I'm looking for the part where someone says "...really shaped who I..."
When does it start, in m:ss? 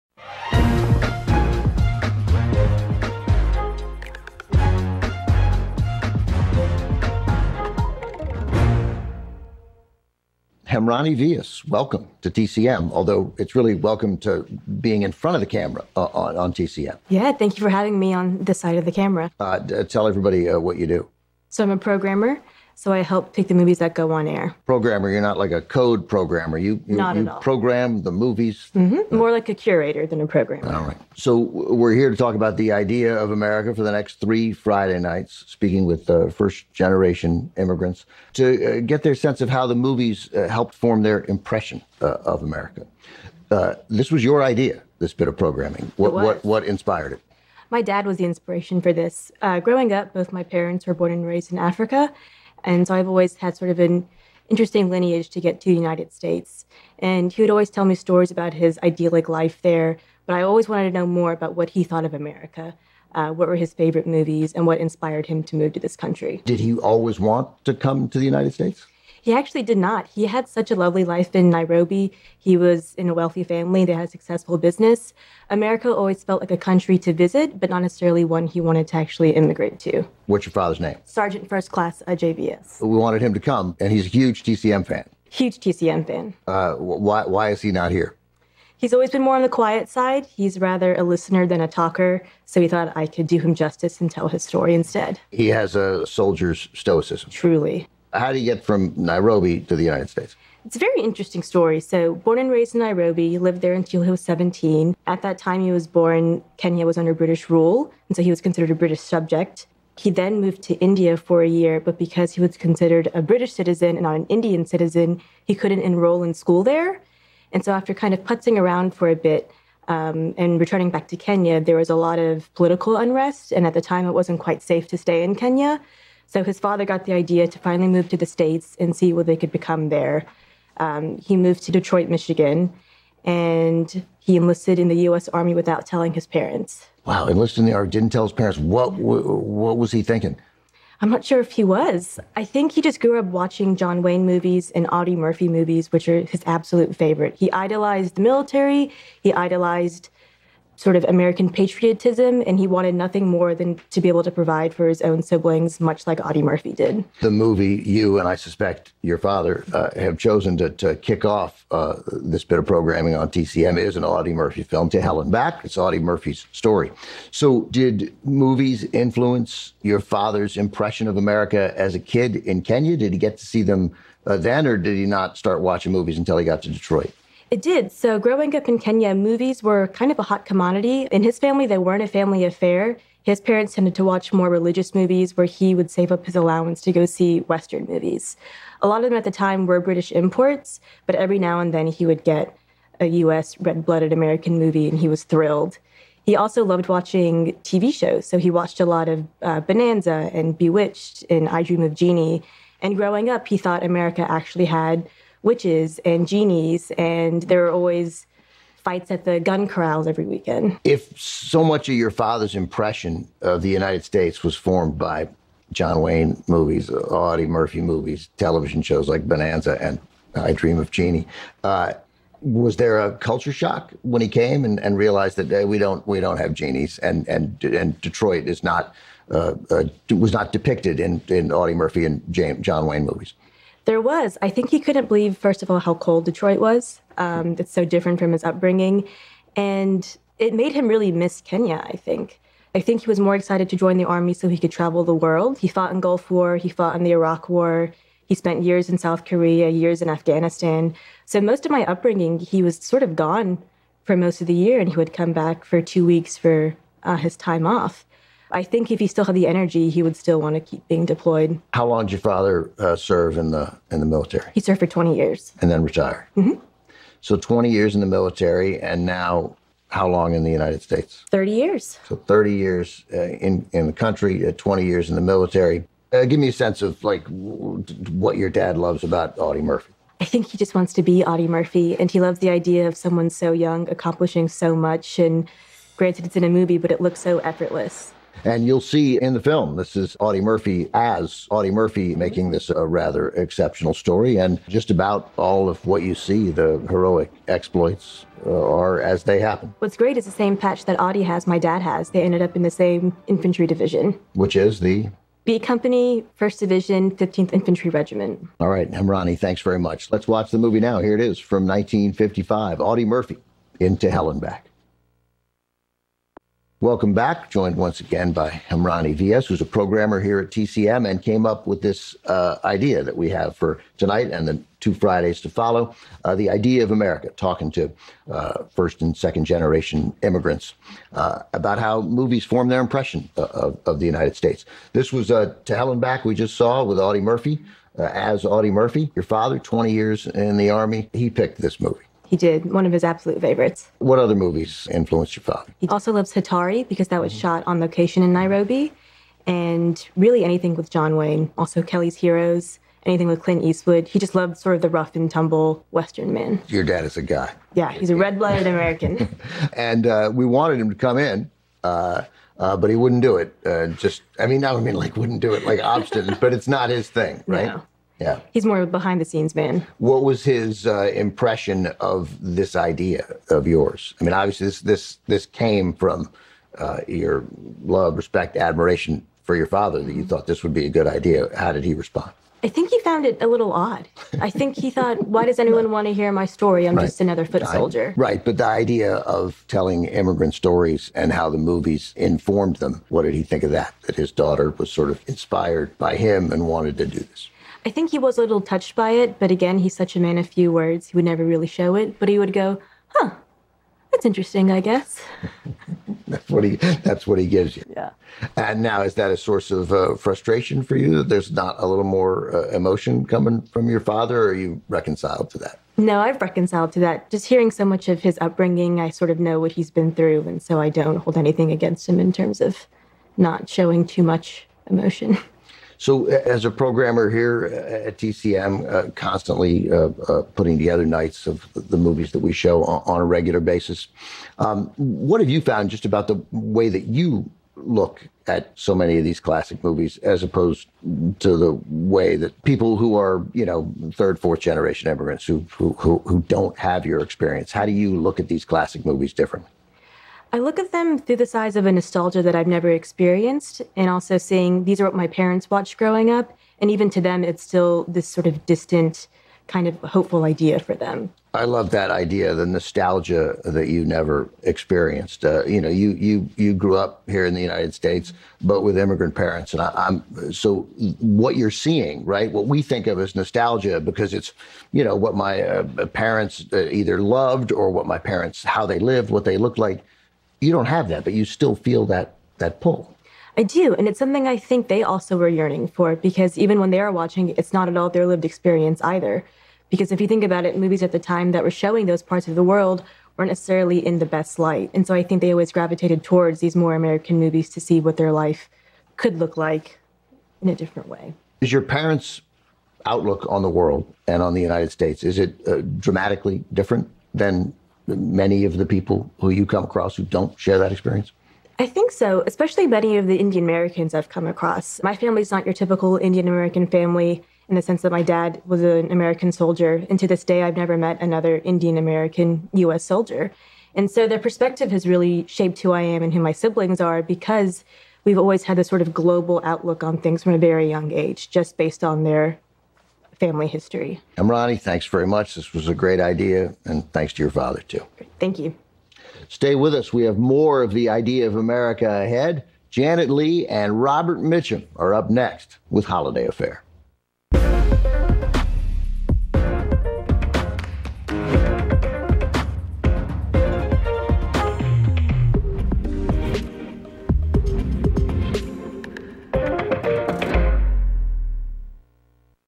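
8:45.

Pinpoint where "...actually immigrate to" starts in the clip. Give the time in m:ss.
1:18.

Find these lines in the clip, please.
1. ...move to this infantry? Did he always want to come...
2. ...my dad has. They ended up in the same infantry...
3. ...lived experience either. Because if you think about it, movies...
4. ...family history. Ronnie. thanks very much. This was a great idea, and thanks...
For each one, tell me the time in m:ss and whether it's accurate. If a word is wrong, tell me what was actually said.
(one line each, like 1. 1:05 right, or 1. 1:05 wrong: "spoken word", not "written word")
1. 1:05 wrong: "country", not "infantry"
2. 5:01 right
3. 8:08 right
4. 8:53 right.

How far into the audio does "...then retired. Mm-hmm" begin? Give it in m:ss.
4:25.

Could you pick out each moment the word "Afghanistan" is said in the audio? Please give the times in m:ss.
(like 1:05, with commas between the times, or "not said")
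4:10.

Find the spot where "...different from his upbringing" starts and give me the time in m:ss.
3:57.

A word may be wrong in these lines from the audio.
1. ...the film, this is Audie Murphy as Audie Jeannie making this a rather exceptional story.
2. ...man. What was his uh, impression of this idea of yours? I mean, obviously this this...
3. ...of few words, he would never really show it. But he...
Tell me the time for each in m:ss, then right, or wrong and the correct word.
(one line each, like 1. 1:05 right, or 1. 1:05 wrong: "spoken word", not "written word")
1. 4:49 wrong: "Murphy", not "Jeannie"
2. 6:09 right
3. 6:40 right.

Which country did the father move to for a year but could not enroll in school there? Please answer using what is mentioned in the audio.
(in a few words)
India.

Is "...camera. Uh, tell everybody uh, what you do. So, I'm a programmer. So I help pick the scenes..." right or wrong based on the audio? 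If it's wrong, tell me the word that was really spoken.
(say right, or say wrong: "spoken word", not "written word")
wrong: "movies", not "scenes".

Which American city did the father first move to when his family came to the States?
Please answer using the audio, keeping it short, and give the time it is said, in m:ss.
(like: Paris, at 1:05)
Detroit, Michigan, at 2:11.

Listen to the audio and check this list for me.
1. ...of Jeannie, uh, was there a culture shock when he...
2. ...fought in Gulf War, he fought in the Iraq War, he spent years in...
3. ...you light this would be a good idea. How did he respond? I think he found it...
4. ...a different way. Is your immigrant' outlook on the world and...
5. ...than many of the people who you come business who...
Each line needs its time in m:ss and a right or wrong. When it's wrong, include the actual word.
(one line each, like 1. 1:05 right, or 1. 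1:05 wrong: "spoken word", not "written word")
1. 3:40 right
2. 4:05 right
3. 6:20 wrong: "thought", not "light"
4. 8:20 wrong: "parents", not "immigrant"
5. 8:27 wrong: "across", not "business".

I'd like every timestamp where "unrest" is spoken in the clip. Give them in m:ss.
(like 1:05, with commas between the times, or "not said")
2:02.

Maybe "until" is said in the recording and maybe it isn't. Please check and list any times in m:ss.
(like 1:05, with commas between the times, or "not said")
1:43, 2:56.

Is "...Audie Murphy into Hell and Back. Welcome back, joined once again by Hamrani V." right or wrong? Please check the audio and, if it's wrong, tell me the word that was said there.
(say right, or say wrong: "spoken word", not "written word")
right.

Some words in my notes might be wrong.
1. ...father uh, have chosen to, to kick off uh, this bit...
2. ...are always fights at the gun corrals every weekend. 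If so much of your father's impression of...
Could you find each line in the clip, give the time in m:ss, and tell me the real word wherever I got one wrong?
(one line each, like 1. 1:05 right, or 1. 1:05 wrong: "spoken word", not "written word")
1. 2:39 right
2. 3:27 right.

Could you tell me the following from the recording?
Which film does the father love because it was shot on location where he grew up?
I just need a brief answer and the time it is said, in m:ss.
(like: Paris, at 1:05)
Hatari, at 5:46.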